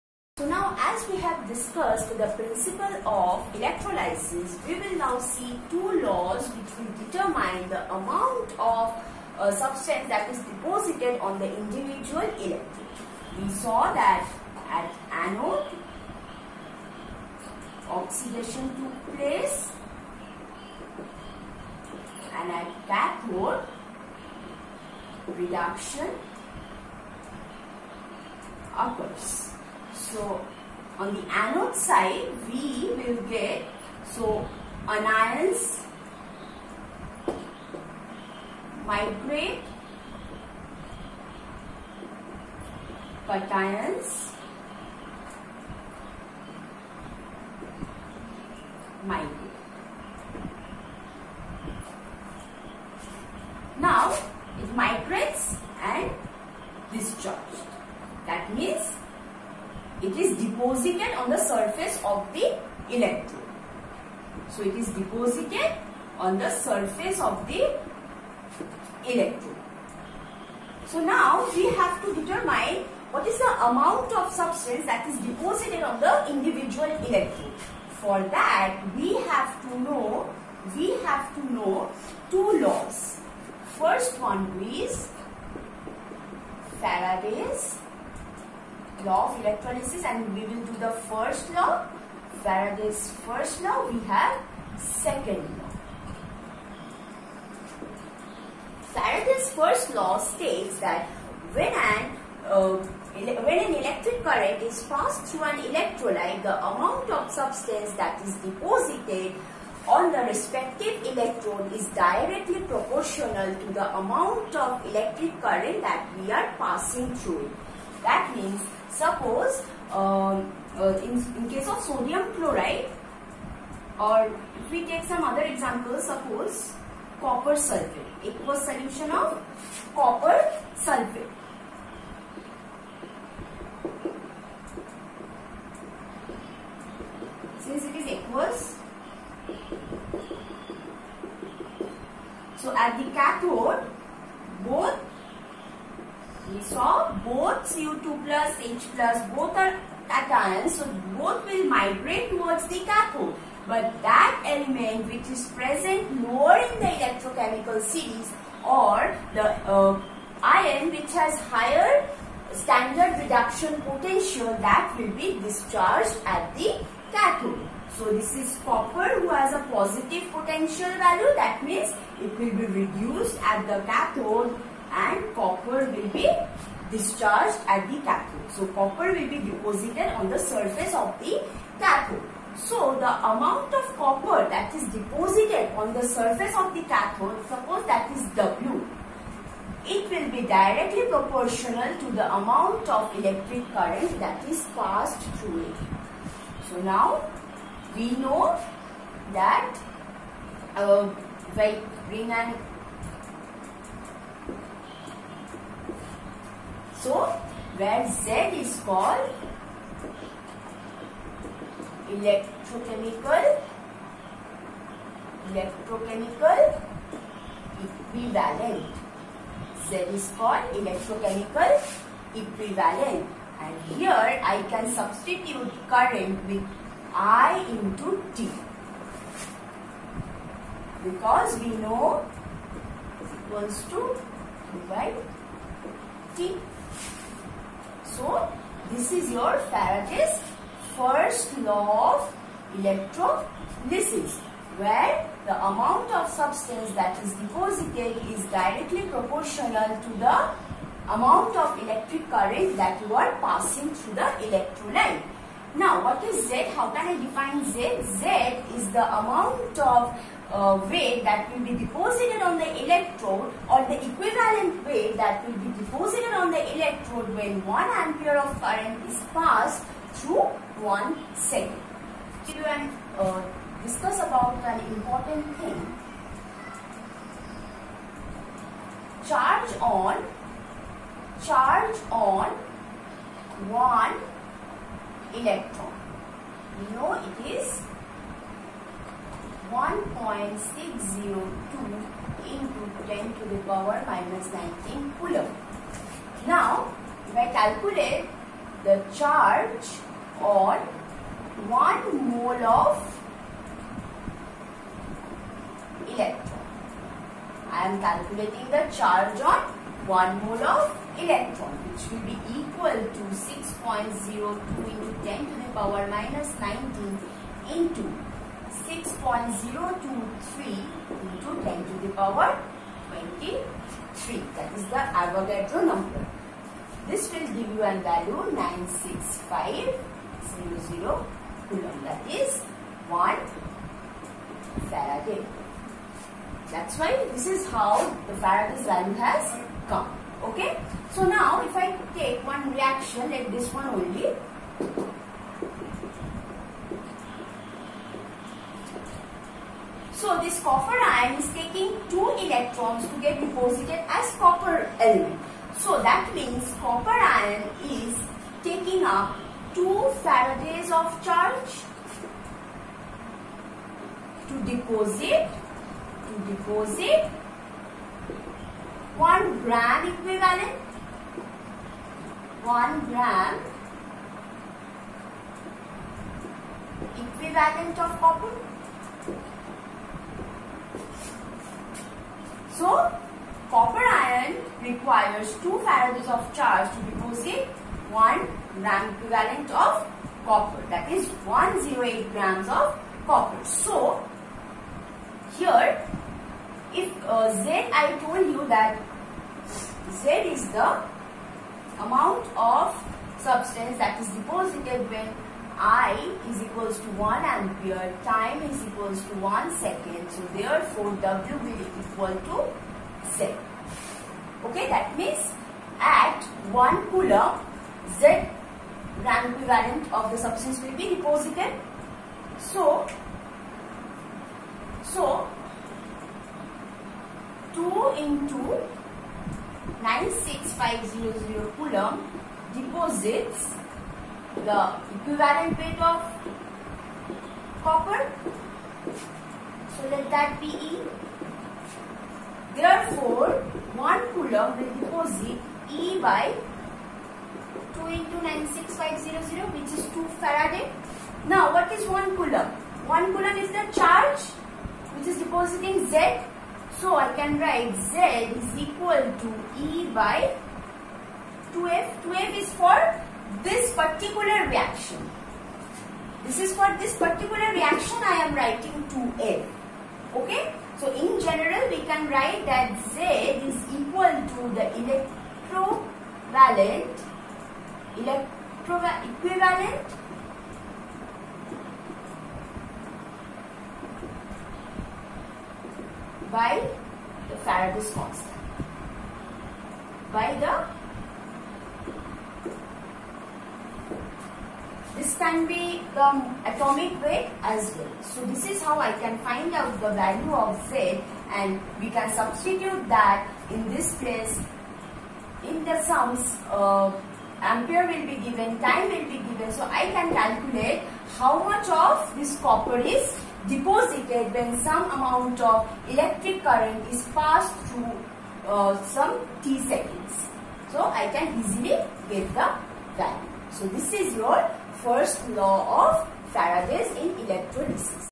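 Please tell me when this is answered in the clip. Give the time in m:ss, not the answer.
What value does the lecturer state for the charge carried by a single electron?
4:49.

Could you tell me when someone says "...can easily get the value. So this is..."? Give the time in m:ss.
8:41.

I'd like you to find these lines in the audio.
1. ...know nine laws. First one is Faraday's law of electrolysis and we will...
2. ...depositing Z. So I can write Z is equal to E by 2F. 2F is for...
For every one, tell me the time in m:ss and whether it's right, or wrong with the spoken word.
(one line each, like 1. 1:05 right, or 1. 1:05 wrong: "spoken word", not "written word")
1. 1:21 wrong: "two", not "nine"
2. 7:35 right.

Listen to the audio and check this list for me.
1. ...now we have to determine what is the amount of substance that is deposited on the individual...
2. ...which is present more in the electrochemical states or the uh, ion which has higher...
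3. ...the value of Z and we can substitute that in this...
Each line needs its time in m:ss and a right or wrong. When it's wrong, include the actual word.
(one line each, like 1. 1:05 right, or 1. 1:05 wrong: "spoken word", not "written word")
1. 1:11 right
2. 2:35 wrong: "series", not "states"
3. 8:20 right.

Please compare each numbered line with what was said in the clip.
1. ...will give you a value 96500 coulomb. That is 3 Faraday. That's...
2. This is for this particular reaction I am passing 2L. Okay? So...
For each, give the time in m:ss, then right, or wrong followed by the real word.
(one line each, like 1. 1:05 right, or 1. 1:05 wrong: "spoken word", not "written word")
1. 5:27 wrong: "1", not "3"
2. 7:46 wrong: "writing", not "passing".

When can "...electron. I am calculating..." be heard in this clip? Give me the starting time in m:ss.
5:06.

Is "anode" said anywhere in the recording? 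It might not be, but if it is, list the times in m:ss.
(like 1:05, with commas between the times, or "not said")
0:15, 0:31.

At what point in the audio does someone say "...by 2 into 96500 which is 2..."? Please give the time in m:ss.
7:26.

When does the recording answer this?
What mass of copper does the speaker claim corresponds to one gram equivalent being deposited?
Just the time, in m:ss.
6:31.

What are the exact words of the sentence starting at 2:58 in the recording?
So copper will be deposited on the surface of the cathode.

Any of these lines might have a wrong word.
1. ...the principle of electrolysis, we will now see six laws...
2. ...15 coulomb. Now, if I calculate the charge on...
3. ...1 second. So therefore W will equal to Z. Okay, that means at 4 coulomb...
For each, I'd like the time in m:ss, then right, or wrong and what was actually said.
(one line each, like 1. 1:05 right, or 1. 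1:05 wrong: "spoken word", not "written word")
1. 0:02 wrong: "two", not "six"
2. 4:54 wrong: "19", not "15"
3. 6:49 wrong: "1", not "4".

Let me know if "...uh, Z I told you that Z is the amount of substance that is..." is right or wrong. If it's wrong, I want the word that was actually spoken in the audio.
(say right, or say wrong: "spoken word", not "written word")
right.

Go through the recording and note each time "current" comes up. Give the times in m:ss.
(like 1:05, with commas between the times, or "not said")
1:44, 1:55, 3:13, 3:45, 4:12, 4:24, 4:28, 8:36.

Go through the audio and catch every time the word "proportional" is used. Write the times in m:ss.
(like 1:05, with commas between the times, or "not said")
1:52, 3:11, 4:09.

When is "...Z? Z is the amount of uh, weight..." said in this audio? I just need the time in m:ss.
4:17.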